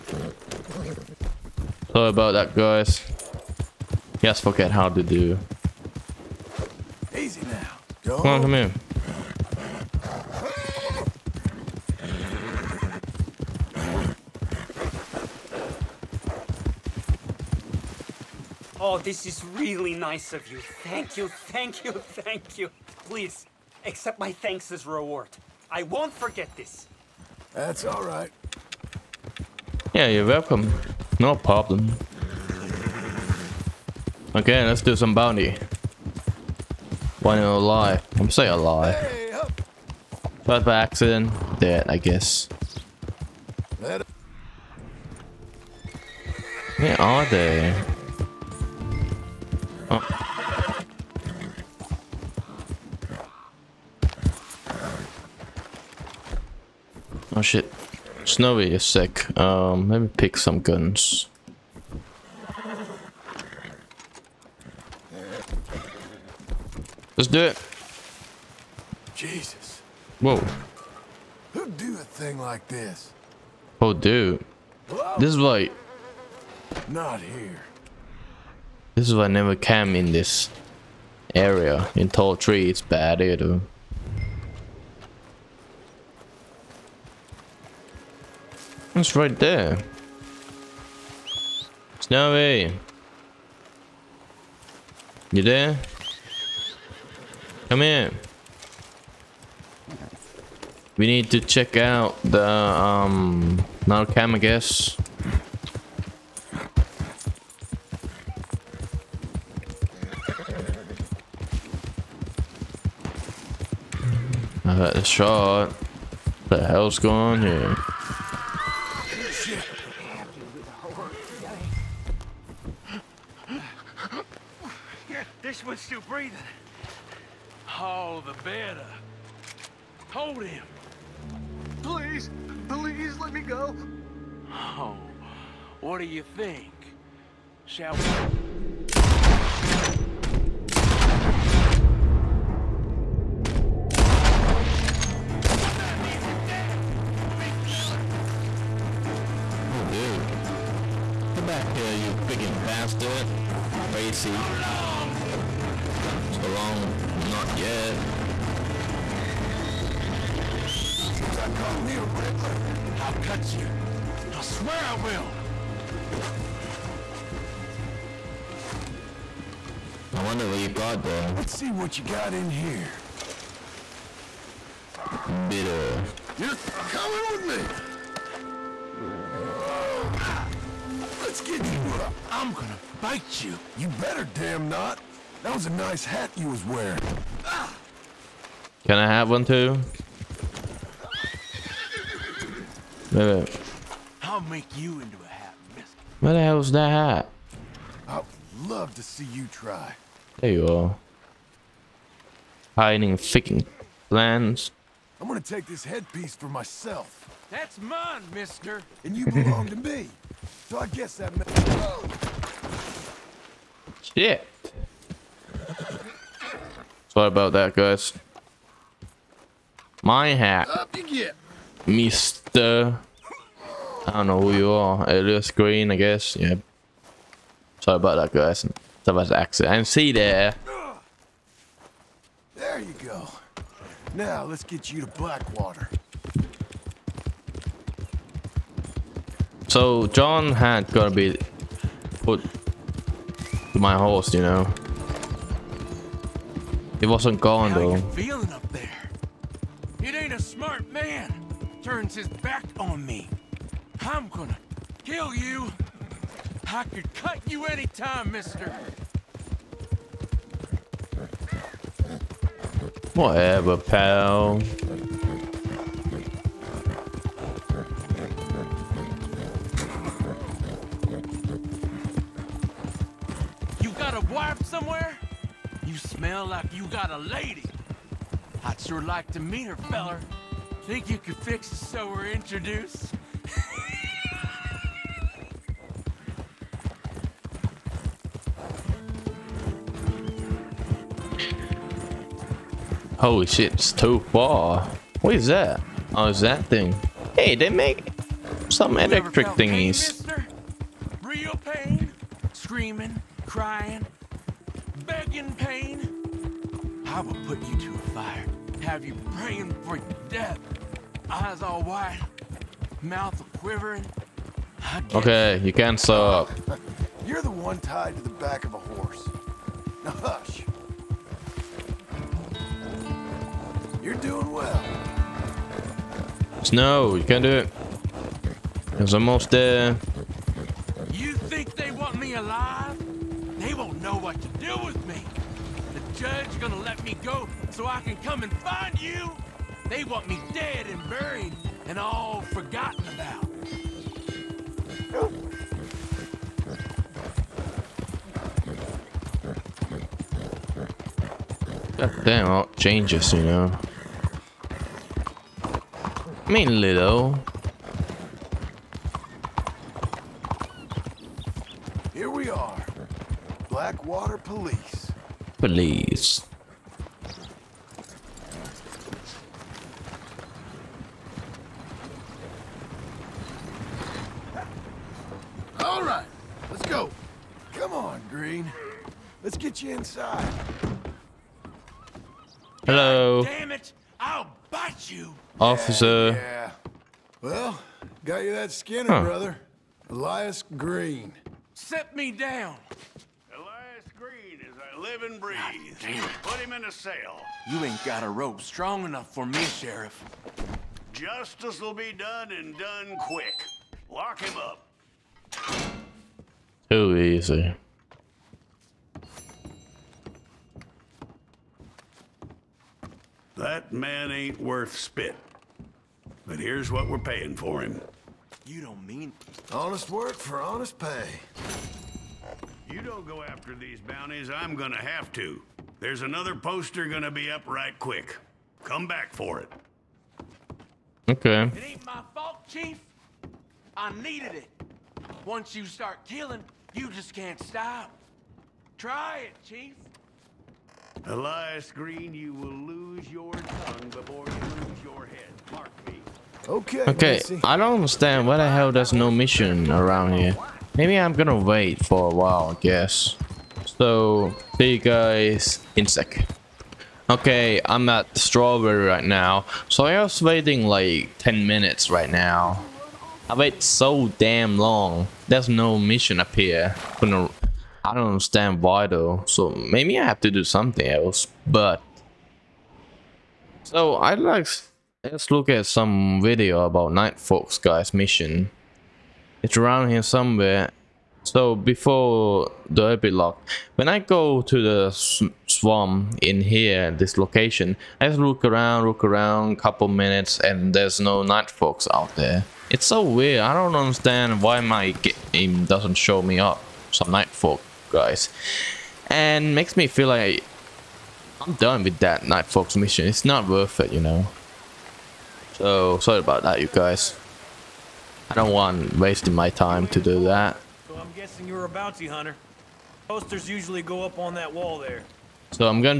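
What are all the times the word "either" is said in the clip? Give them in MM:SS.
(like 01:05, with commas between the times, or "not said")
01:23.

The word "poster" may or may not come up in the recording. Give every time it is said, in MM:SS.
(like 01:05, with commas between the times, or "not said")
07:06, 08:33.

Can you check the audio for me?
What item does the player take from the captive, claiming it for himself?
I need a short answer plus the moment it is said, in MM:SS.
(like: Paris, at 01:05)
headpiece, at 03:25.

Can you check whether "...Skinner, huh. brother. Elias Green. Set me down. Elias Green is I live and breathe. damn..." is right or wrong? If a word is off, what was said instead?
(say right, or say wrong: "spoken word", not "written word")
right.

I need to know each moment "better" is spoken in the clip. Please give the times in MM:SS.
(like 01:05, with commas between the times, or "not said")
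02:08, 03:03.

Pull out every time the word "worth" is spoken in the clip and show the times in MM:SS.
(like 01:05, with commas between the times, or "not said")
06:54, 08:23.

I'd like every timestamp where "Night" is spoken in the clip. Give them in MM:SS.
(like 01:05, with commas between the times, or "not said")
07:57, 08:11, 08:17, 08:22.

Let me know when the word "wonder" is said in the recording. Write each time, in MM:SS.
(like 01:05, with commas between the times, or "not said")
02:50.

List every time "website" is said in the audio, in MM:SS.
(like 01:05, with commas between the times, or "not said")
not said.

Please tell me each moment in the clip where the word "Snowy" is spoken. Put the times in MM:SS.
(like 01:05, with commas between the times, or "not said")
00:58, 01:31.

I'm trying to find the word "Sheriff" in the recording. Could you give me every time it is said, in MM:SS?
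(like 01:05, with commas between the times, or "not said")
06:39.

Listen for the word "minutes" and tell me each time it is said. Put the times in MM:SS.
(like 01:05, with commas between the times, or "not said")
07:41, 08:10.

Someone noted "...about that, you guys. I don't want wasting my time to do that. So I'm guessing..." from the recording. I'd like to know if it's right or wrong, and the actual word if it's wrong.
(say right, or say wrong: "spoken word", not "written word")
right.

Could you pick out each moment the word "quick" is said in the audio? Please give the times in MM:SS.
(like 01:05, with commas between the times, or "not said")
06:43, 07:07.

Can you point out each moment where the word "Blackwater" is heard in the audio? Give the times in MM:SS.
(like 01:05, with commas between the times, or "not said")
03:55, 06:03.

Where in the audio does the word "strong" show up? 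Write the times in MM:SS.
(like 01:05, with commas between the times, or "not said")
06:38.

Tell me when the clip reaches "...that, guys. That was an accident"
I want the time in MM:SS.
03:48.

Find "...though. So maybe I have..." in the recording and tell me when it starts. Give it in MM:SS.
07:49.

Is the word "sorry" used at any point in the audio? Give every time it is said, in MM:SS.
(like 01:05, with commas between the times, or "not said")
03:37, 03:47, 08:26.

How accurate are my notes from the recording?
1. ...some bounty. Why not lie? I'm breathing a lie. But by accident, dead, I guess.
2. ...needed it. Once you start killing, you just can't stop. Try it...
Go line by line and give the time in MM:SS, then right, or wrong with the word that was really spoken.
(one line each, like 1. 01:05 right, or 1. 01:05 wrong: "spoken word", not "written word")
1. 00:34 wrong: "saying", not "breathing"
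2. 07:14 right.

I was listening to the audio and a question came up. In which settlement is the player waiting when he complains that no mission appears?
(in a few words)
Strawberry.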